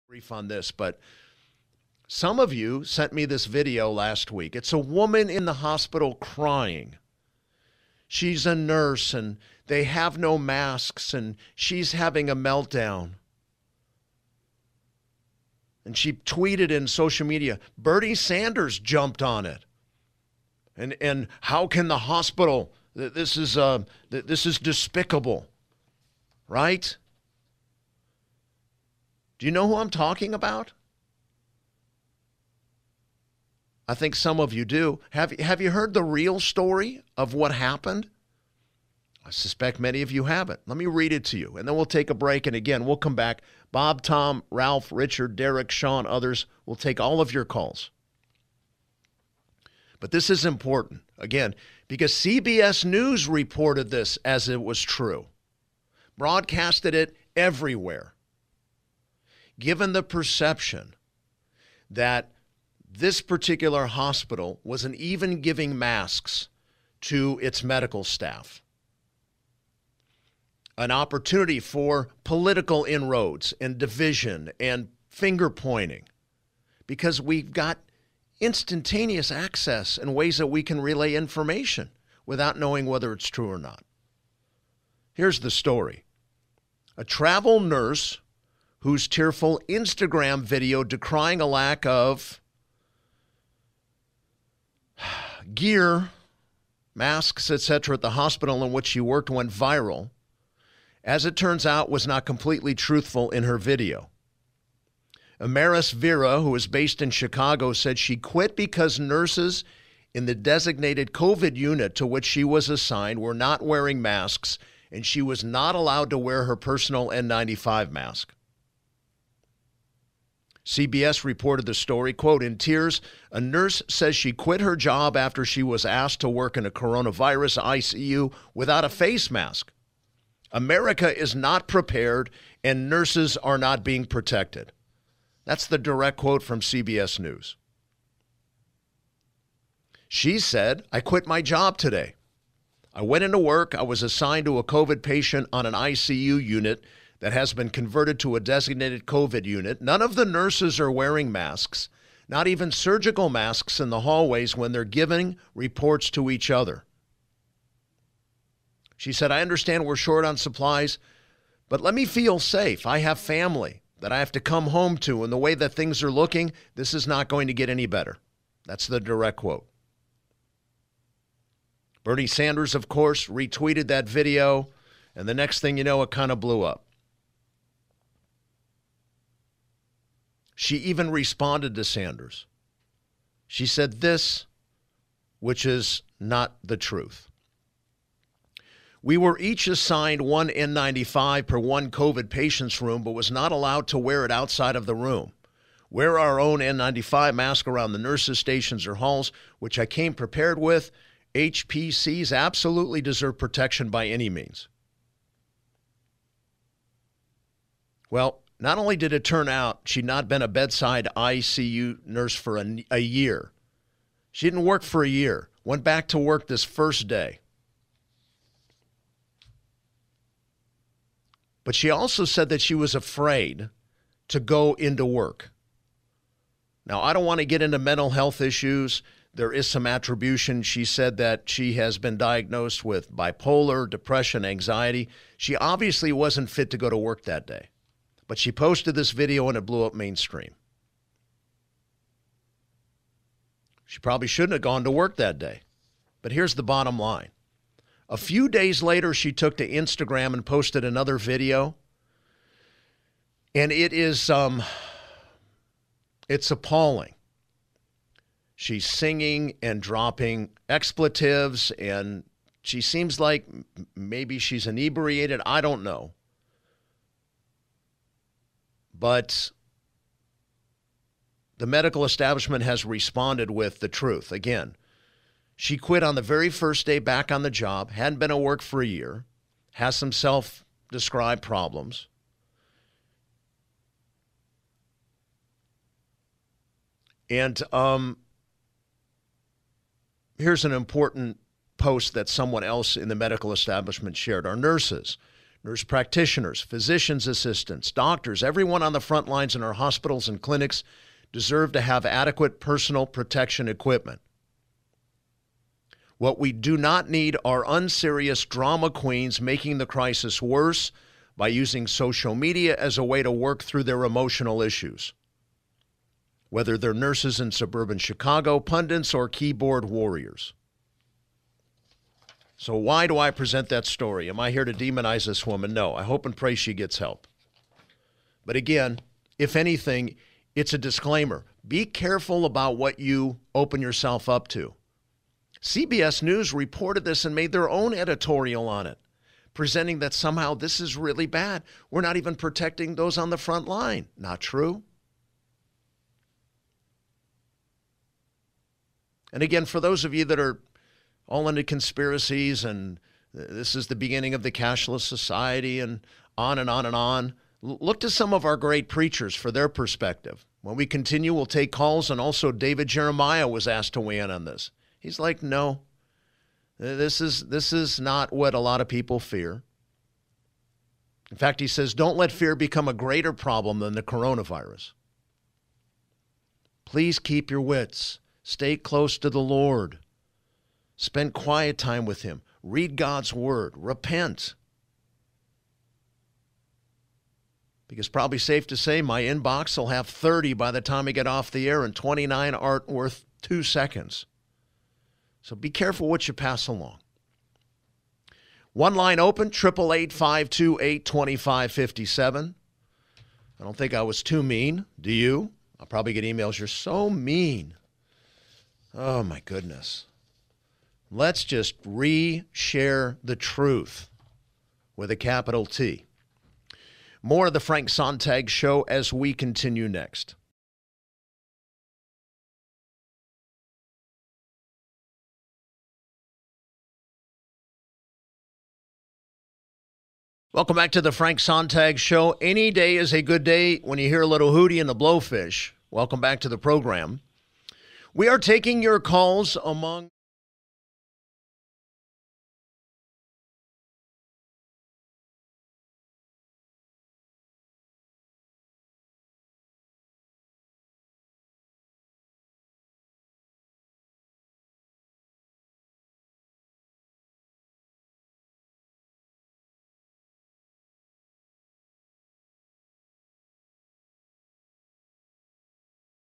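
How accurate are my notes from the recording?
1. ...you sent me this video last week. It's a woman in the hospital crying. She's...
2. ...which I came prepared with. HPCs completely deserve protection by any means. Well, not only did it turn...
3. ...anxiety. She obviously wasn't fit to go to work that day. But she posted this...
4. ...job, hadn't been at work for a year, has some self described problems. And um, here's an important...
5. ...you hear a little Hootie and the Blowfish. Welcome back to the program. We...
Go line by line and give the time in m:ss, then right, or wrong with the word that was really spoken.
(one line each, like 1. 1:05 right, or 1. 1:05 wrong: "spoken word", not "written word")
1. 0:02 right
2. 3:19 wrong: "absolutely", not "completely"
3. 3:54 right
4. 4:37 right
5. 7:13 right.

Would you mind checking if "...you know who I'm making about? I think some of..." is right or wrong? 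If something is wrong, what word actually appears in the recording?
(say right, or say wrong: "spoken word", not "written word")
wrong: "talking", not "making".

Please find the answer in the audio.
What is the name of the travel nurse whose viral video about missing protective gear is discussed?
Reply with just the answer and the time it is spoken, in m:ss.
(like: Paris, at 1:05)
Amaris Vera, at 1:45.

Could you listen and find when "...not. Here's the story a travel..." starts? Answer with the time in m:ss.
1:23.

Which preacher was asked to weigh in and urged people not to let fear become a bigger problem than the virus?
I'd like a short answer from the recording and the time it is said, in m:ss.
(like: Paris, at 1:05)
David Jeremiah, at 6:02.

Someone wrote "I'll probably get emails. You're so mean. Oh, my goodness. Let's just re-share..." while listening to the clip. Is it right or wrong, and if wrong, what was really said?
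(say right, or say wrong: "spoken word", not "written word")
right.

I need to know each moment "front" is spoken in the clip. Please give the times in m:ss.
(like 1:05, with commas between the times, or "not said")
4:59, 5:43.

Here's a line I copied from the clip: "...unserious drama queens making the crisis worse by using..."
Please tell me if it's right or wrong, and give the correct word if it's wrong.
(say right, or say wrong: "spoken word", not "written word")
right.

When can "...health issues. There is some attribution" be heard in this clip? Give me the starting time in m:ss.
3:48.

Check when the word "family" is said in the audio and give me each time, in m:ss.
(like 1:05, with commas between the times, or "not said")
2:43.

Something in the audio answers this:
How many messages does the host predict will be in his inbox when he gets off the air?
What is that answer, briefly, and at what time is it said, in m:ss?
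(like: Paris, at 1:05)
30, at 6:30.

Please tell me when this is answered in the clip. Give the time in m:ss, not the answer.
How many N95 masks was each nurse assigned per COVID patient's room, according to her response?
3:10.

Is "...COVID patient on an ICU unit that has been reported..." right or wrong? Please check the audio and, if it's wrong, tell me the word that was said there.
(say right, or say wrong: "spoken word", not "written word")
wrong: "converted", not "reported".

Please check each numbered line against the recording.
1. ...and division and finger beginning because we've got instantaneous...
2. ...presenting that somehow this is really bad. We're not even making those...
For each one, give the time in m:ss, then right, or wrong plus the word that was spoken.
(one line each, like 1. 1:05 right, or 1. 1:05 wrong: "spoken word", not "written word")
1. 1:13 wrong: "pointing", not "beginning"
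2. 5:39 wrong: "protecting", not "making".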